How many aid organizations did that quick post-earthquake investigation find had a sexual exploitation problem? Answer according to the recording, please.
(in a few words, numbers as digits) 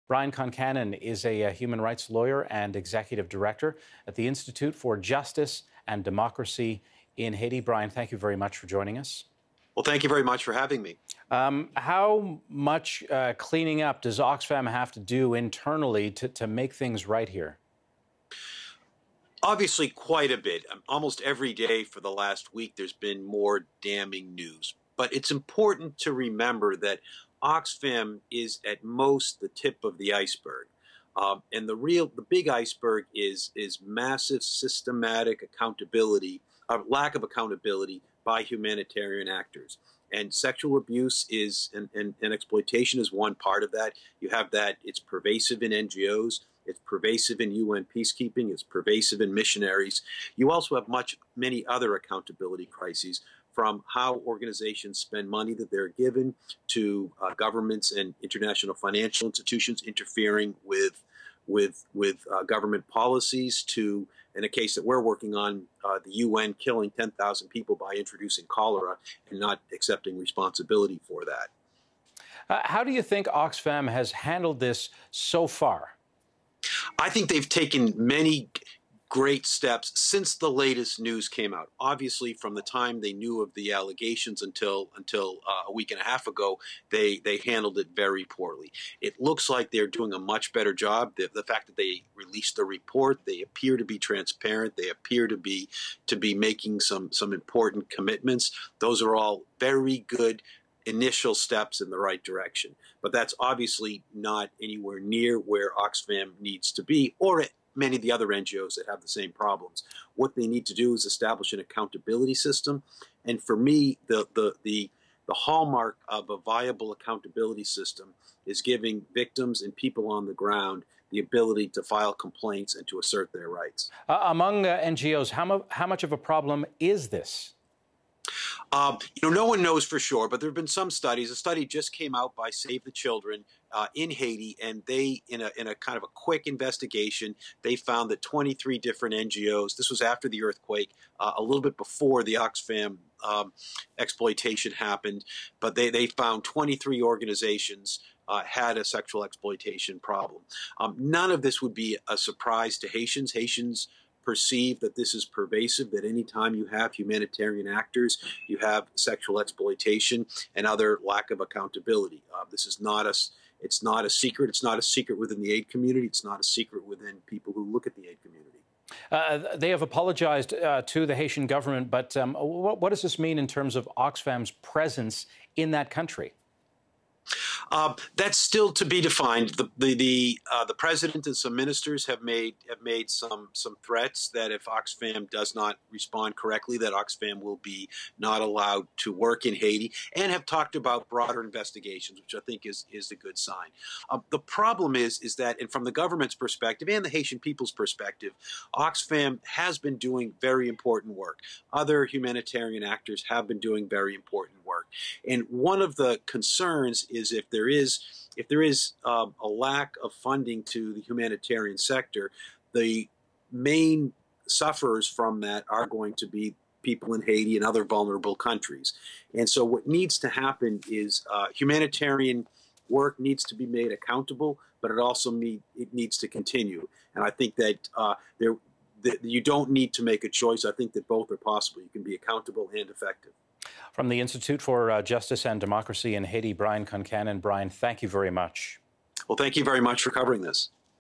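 23.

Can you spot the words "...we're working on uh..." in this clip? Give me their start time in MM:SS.
01:04.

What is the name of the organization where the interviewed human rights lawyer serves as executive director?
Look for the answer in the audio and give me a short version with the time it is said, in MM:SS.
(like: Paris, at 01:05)
Institute for Justice and Democracy in Haiti, at 00:04.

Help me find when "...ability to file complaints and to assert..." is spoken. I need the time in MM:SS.
02:01.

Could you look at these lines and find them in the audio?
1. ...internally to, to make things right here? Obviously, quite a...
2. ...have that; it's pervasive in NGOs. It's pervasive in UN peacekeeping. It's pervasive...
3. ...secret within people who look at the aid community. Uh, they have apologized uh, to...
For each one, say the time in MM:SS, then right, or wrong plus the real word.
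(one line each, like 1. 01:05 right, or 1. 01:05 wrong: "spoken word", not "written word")
1. 00:15 right
2. 00:44 right
3. 02:46 right.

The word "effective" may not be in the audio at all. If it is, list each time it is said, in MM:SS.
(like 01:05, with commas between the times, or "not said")
03:52.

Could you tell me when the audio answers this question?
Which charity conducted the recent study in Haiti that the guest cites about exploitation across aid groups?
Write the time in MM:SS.
02:12.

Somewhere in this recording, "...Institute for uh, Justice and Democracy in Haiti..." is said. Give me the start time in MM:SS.
03:54.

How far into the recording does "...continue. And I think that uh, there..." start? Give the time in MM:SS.
03:46.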